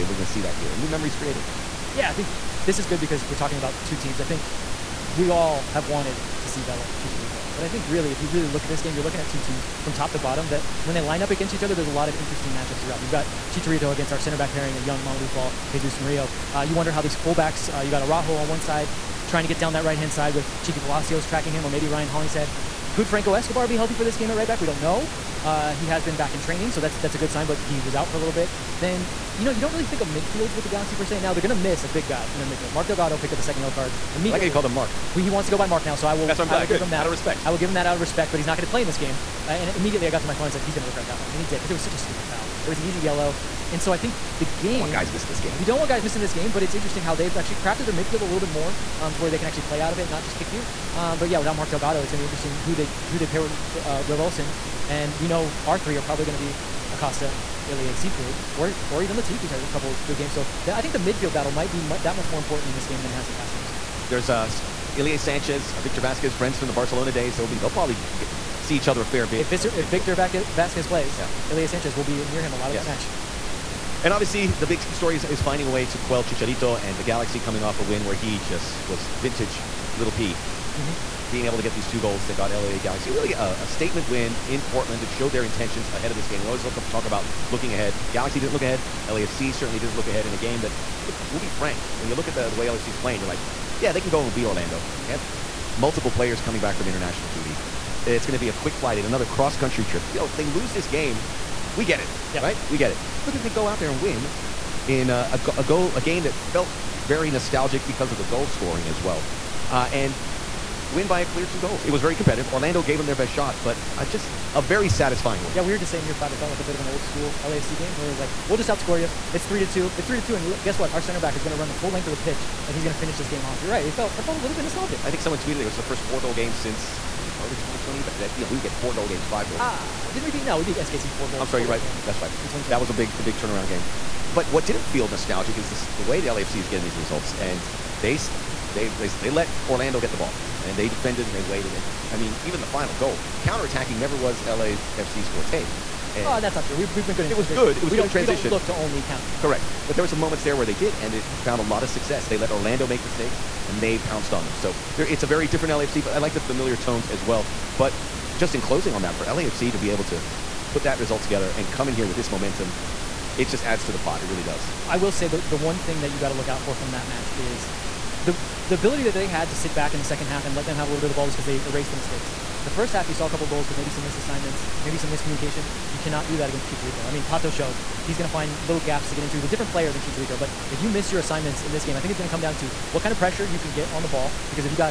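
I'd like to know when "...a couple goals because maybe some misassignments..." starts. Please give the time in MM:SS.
02:53.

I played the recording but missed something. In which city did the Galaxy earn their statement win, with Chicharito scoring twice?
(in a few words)
Portland.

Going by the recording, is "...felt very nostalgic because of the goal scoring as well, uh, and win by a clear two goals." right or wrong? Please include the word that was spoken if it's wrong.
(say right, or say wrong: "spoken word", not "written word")
right.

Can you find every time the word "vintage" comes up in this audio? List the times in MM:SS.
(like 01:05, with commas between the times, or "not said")
01:19.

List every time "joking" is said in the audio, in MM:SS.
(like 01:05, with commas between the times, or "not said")
not said.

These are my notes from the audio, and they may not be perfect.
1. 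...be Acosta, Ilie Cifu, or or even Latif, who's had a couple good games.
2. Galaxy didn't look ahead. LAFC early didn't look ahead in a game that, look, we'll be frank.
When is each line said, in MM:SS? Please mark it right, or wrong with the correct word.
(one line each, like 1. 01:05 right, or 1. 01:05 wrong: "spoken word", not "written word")
1. 00:56 right
2. 01:28 wrong: "certainly", not "early".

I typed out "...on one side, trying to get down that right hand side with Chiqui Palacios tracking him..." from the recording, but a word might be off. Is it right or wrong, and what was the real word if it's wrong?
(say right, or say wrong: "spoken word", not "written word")
right.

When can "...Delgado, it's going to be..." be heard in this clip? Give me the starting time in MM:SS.
00:51.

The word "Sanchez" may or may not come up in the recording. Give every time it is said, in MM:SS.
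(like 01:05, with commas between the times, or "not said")
01:05, 01:11.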